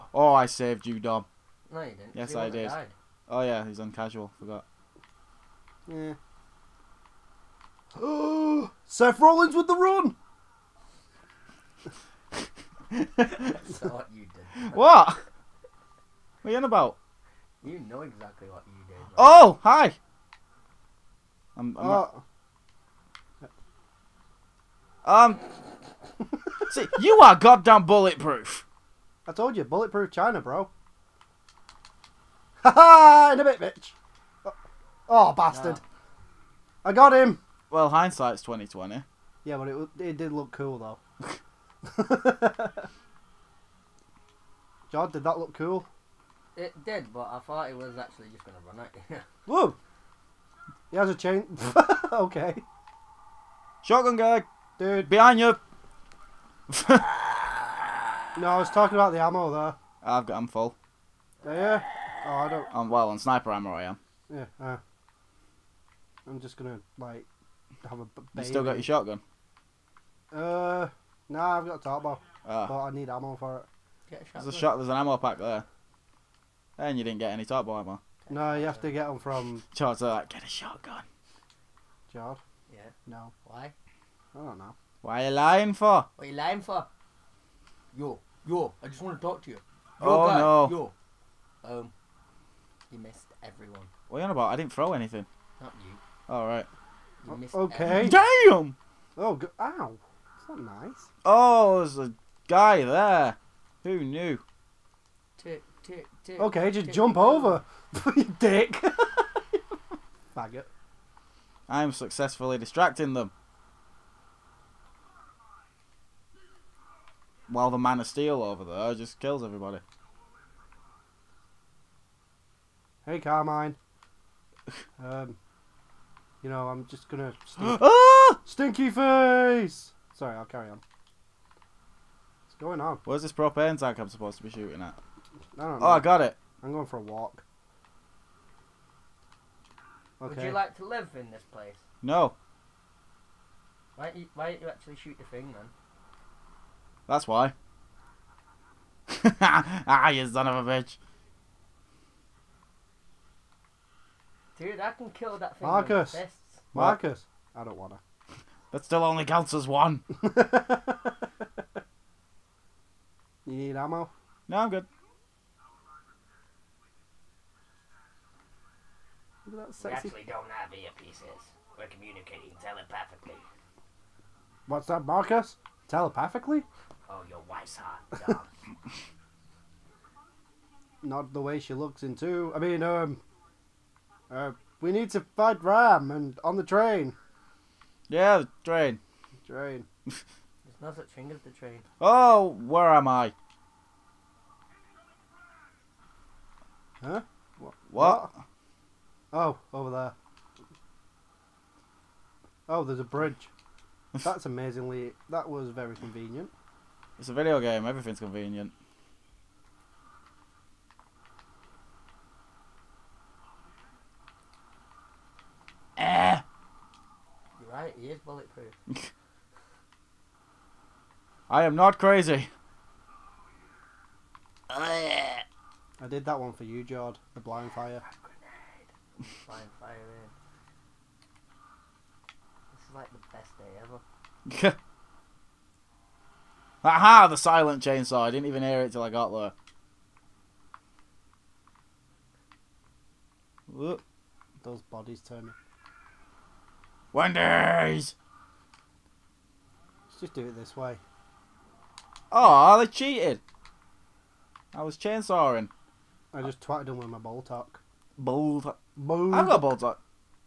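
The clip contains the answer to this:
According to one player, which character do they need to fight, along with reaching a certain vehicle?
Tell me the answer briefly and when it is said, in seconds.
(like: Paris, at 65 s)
RAAM, at 185 s.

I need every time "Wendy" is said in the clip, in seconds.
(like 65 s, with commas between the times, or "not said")
247 s.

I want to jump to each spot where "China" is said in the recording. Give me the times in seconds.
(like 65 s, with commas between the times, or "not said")
30 s.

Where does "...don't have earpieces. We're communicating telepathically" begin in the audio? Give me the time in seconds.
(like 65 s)
170 s.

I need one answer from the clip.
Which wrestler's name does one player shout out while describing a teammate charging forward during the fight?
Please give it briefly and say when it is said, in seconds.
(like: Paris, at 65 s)
Seth Rollins, at 8 s.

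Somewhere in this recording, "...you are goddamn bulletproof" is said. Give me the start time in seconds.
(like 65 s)
26 s.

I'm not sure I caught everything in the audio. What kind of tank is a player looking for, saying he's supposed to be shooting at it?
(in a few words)
Propane tank.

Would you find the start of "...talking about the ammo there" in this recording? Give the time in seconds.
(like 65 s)
58 s.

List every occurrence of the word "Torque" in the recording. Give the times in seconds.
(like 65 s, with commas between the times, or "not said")
71 s, 77 s.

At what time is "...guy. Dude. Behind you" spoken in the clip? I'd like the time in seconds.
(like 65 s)
54 s.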